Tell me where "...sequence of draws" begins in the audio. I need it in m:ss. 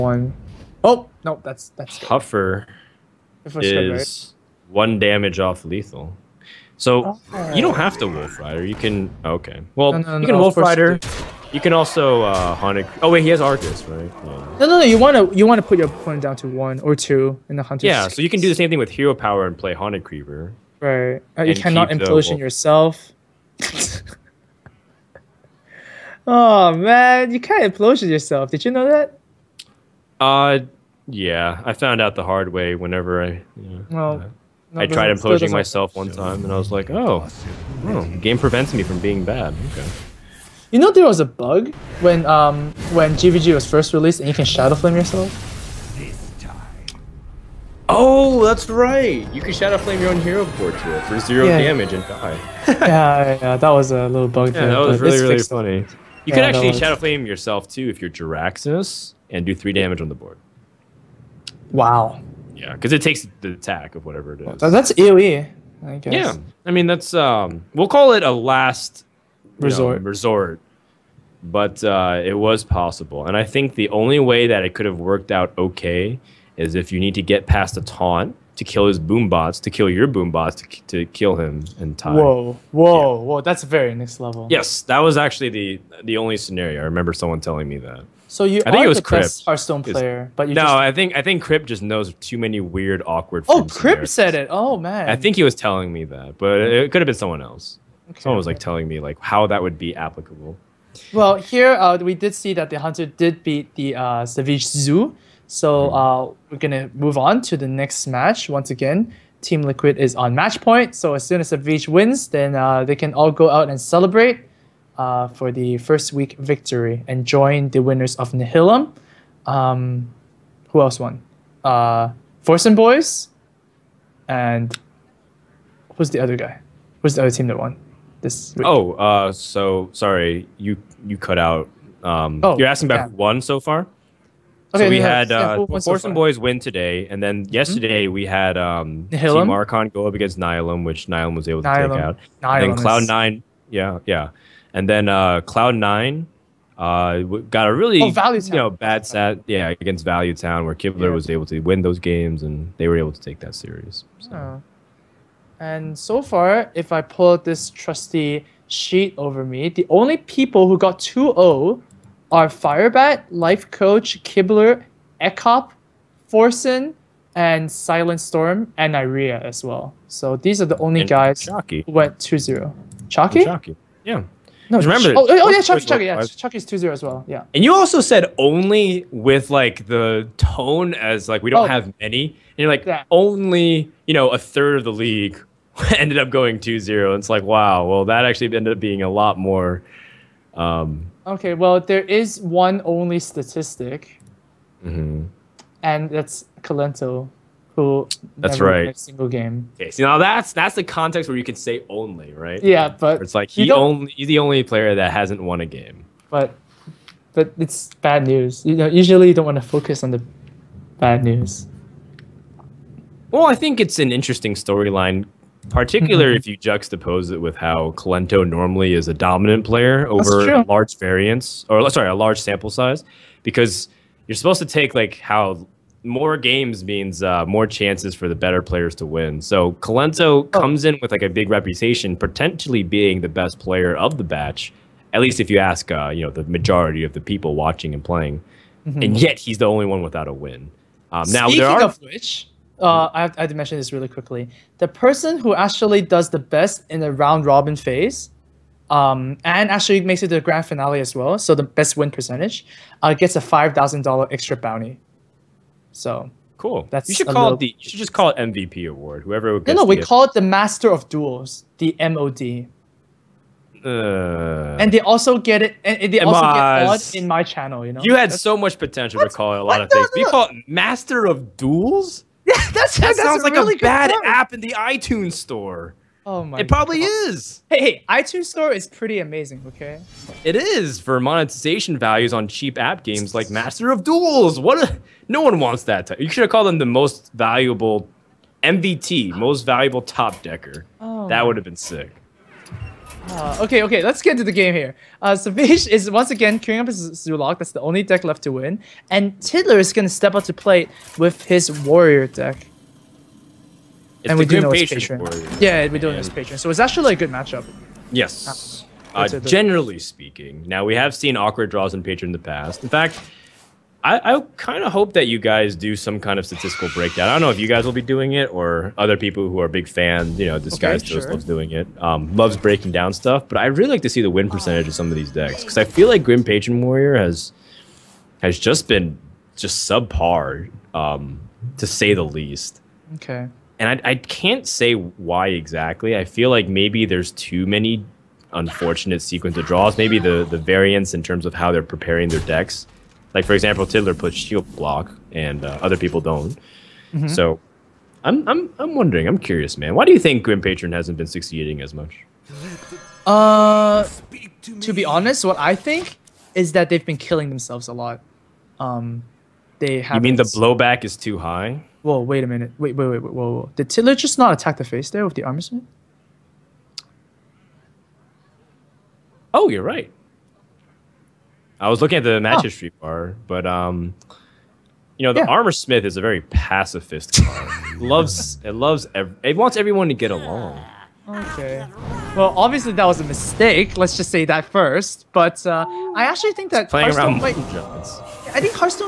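5:39.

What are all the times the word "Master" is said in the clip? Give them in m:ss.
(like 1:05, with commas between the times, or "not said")
4:20, 4:30, 4:43.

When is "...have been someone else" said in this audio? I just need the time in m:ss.
1:37.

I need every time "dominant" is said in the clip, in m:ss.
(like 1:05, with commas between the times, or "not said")
3:39.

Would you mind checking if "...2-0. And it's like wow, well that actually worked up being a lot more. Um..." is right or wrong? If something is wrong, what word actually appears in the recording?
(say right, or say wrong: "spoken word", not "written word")
wrong: "ended", not "worked".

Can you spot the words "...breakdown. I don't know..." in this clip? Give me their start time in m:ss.
5:16.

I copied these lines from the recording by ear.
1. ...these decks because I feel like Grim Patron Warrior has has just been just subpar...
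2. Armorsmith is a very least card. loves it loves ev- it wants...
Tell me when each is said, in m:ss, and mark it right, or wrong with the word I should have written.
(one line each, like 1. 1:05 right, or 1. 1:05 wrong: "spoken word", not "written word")
1. 5:25 right
2. 6:15 wrong: "pacifist", not "least".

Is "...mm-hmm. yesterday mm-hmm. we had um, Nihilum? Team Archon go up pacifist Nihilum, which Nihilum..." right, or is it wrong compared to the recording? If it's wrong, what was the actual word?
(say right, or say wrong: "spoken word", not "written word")
wrong: "against", not "pacifist".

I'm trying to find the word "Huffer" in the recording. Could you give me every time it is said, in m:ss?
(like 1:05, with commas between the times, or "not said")
0:01.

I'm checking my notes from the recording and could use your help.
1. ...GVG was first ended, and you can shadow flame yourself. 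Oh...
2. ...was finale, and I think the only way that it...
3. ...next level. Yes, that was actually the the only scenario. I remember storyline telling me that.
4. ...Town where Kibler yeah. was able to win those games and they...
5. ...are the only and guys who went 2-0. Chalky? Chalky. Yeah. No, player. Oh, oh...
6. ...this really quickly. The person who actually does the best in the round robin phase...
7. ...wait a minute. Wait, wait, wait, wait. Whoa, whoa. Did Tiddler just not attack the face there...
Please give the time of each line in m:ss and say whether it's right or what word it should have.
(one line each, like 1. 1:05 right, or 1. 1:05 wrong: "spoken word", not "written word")
1. 0:43 wrong: "released", not "ended"
2. 1:12 wrong: "possible", not "finale"
3. 1:23 wrong: "someone", not "storyline"
4. 2:30 right
5. 2:50 wrong: "remember", not "player"
6. 4:03 right
7. 6:02 right.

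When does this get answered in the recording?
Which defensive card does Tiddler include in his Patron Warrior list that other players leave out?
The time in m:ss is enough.
5:44.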